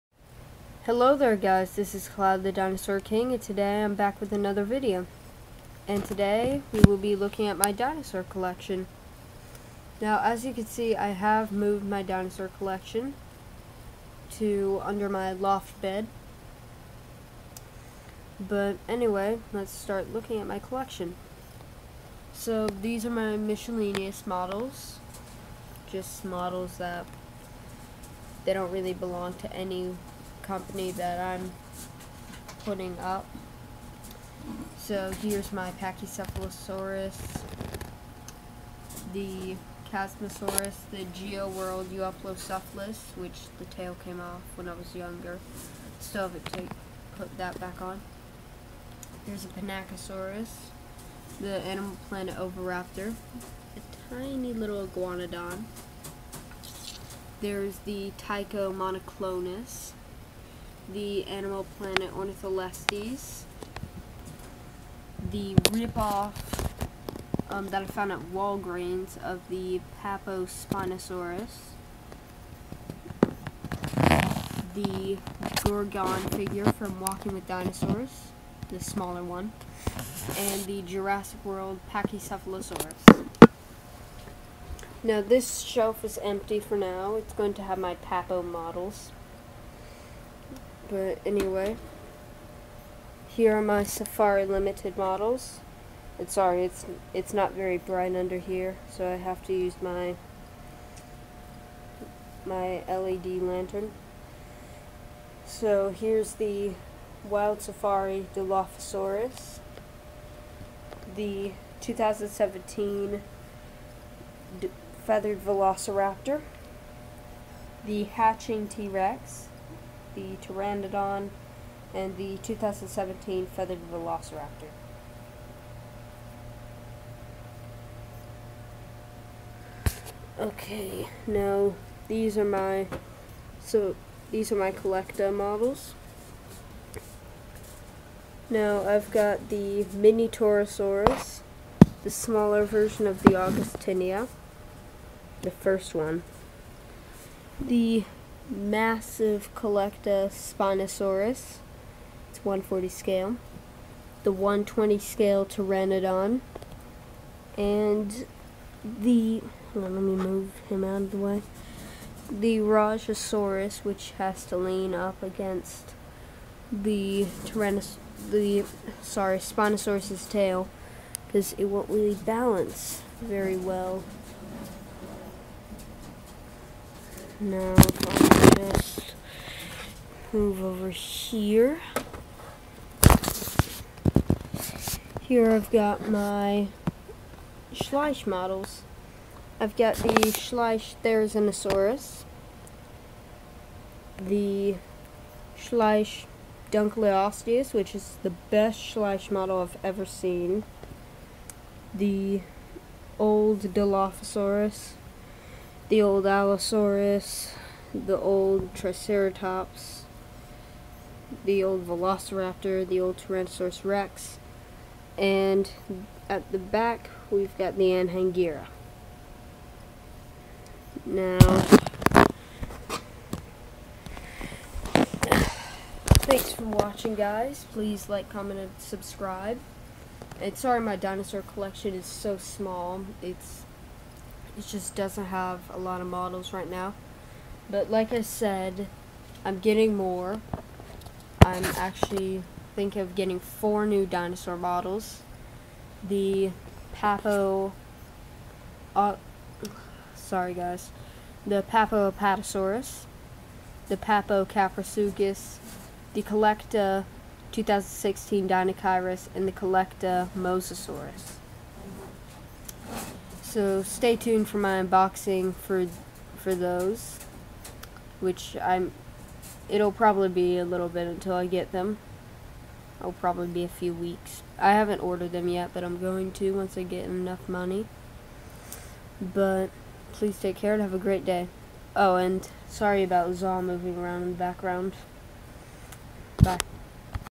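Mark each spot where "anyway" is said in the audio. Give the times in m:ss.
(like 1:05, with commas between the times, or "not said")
0:18, 1:31.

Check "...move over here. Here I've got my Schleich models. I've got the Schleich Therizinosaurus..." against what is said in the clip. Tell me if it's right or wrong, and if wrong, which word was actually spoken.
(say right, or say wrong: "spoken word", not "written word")
right.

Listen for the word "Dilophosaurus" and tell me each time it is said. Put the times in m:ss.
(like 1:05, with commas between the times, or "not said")
1:48, 3:23.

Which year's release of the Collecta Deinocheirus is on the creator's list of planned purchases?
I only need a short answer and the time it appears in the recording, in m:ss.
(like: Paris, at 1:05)
2016, at 4:17.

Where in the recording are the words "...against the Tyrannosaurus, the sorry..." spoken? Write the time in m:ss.
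2:45.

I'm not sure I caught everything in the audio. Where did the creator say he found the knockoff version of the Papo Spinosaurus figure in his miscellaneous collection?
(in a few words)
Walgreens.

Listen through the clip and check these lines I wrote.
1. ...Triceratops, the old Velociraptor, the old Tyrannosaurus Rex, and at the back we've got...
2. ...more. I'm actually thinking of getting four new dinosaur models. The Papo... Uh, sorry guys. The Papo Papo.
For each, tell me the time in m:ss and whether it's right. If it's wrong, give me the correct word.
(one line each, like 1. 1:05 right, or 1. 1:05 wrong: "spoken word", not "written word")
1. 3:28 right
2. 3:59 wrong: "Apatosaurus", not "Papo".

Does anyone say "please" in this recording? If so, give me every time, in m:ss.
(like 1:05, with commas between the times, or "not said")
3:47, 4:40.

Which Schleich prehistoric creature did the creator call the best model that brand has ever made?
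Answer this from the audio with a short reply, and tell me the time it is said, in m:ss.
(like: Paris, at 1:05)
Dunkleosteus, at 3:16.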